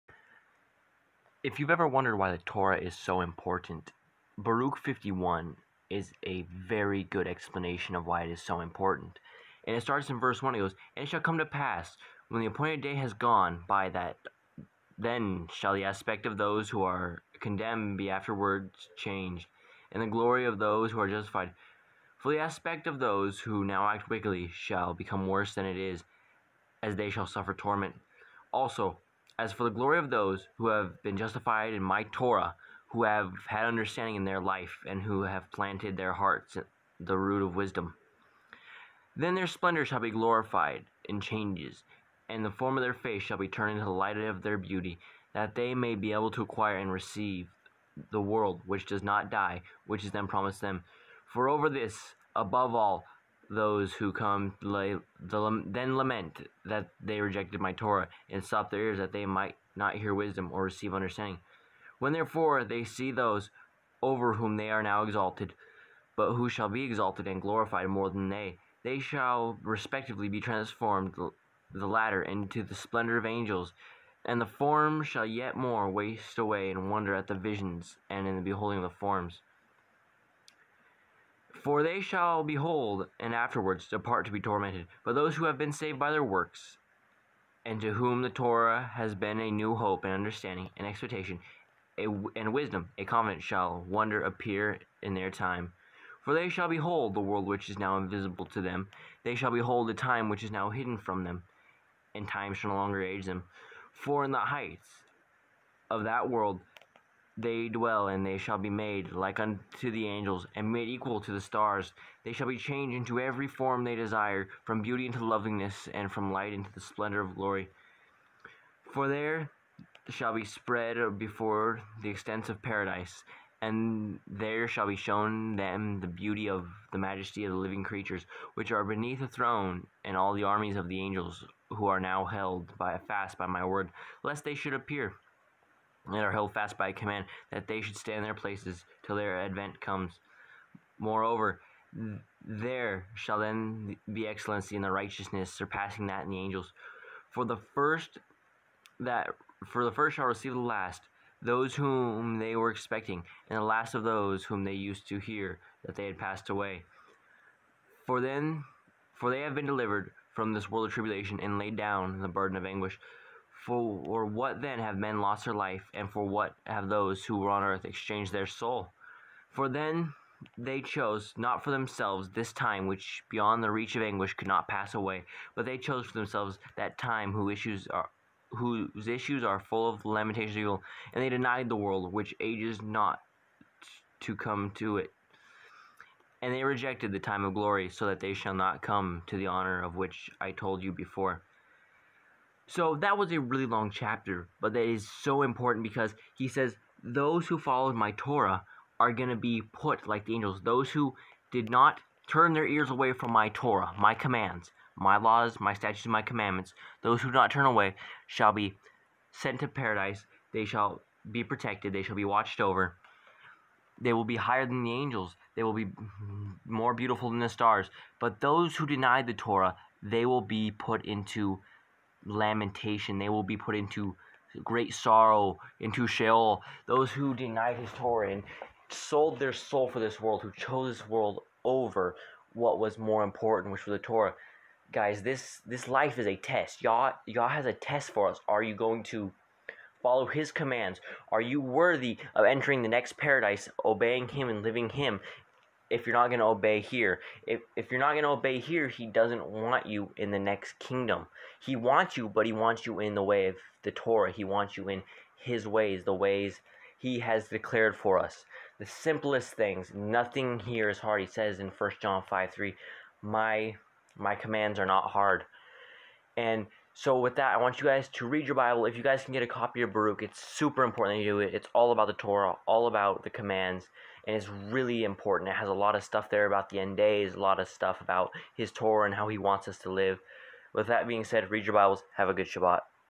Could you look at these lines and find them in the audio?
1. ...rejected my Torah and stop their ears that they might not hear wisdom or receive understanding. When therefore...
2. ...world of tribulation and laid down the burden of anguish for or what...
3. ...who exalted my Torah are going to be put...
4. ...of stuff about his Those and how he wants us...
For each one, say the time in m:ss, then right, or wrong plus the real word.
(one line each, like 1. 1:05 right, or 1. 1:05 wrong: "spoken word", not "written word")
1. 0:57 right
2. 2:40 right
3. 3:17 wrong: "followed", not "exalted"
4. 4:37 wrong: "Torah", not "Those".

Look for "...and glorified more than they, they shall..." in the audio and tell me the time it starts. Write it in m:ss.
1:07.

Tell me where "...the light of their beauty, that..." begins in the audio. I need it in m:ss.
0:43.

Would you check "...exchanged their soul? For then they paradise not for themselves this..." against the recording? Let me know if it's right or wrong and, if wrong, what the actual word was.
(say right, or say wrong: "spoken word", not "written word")
wrong: "chose", not "paradise".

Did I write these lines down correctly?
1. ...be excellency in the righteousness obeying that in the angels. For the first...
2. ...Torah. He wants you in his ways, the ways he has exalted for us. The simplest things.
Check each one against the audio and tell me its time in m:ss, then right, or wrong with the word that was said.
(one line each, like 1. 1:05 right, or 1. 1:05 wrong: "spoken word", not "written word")
1. 2:24 wrong: "surpassing", not "obeying"
2. 4:13 wrong: "declared", not "exalted".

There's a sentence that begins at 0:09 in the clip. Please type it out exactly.
And it starts in verse 1.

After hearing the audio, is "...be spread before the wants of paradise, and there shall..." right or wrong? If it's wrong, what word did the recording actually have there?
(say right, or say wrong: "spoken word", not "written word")
wrong: "extents", not "wants".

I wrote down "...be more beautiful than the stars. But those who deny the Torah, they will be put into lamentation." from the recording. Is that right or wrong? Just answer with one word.
right.